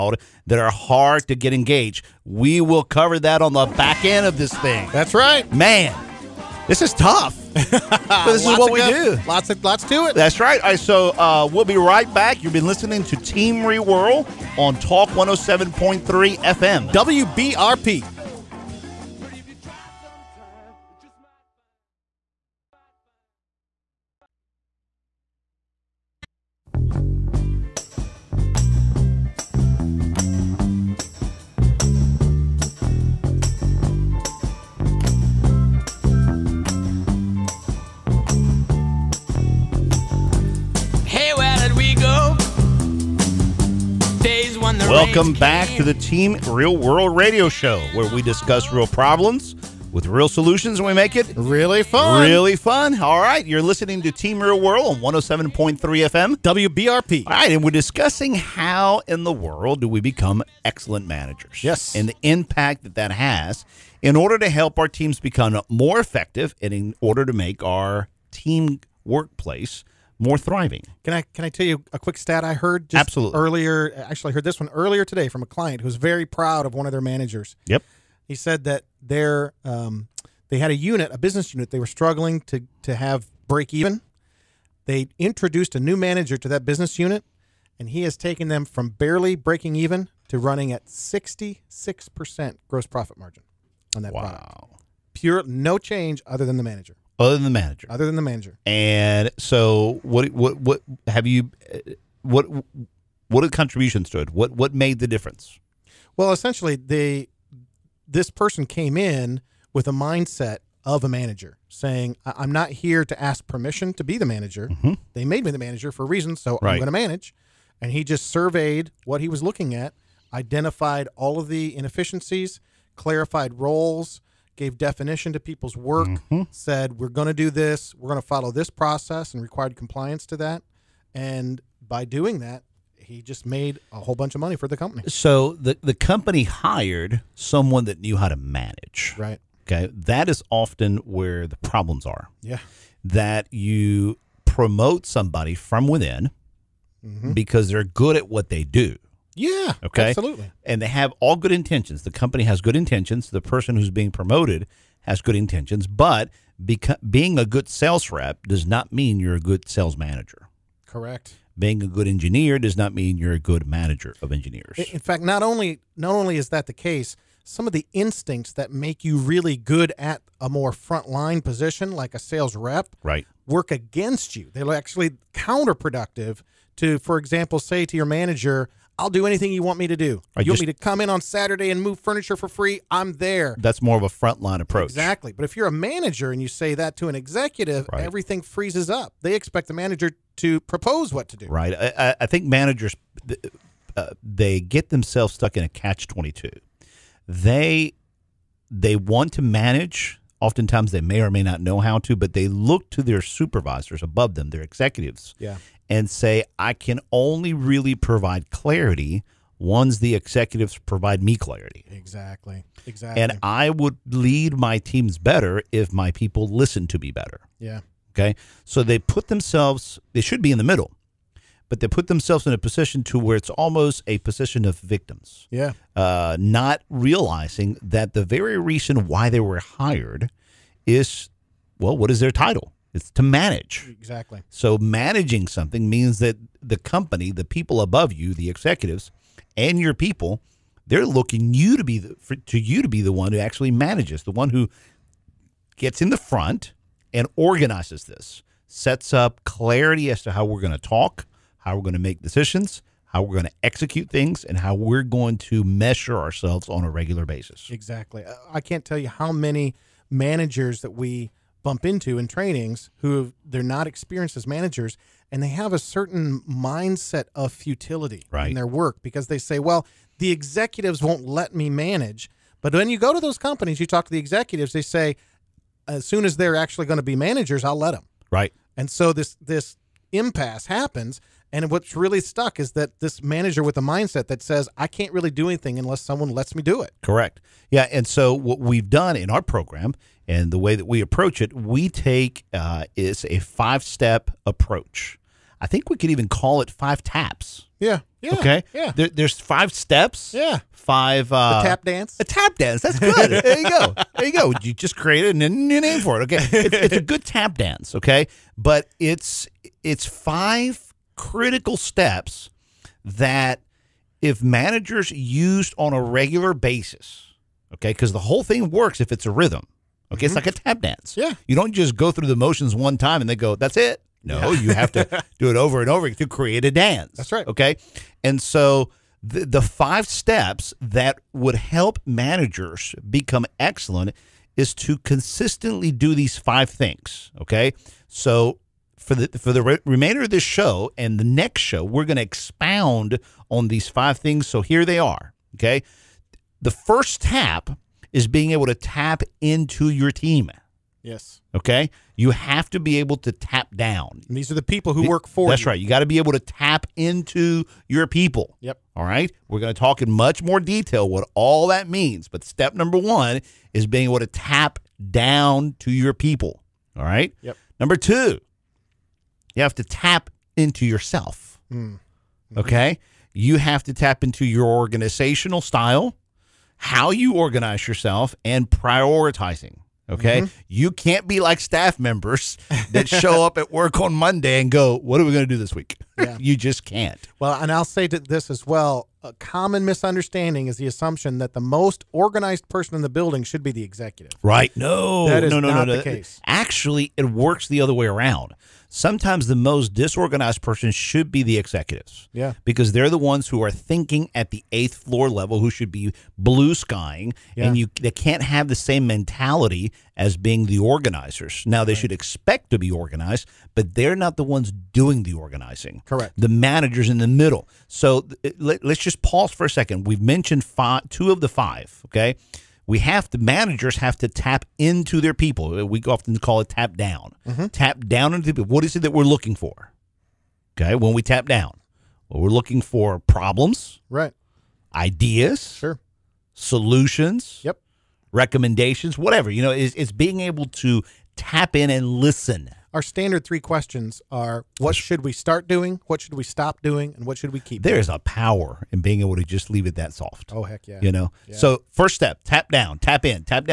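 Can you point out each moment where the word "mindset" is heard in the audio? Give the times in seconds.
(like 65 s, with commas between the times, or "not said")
109 s, 266 s, 283 s.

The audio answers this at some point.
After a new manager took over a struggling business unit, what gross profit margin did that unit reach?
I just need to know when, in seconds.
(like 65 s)
90 s.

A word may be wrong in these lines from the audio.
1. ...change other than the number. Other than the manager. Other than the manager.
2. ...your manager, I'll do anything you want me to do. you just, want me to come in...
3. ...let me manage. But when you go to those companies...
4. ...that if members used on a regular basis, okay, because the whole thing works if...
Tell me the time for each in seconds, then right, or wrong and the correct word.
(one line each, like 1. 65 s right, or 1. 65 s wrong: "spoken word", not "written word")
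1. 95 s wrong: "manager", not "number"
2. 177 s right
3. 271 s right
4. 313 s wrong: "managers", not "members".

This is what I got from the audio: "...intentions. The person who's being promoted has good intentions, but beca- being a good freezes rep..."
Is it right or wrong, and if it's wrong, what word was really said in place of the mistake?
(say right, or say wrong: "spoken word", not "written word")
wrong: "sales", not "freezes".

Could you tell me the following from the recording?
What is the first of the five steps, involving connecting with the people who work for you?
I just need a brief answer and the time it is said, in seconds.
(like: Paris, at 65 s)
tap into your team, at 348 s.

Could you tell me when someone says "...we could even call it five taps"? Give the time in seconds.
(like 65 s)
295 s.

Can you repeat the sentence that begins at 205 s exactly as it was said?
Yeah and say, I can only really provide clarity once the executives provide me clarity.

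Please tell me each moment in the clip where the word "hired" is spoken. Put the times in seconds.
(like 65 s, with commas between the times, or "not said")
136 s, 229 s.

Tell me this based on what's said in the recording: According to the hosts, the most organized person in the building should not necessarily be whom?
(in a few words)
the executive.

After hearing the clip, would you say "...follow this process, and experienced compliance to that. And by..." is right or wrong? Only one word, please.
wrong.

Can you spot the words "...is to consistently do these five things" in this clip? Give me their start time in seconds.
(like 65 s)
334 s.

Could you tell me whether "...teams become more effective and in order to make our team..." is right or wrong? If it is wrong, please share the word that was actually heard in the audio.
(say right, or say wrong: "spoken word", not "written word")
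right.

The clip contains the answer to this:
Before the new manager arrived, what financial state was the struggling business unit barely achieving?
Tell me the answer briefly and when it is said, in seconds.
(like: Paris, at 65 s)
break even, at 83 s.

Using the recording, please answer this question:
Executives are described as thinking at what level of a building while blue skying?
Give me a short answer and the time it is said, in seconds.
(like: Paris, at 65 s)
eighth floor, at 404 s.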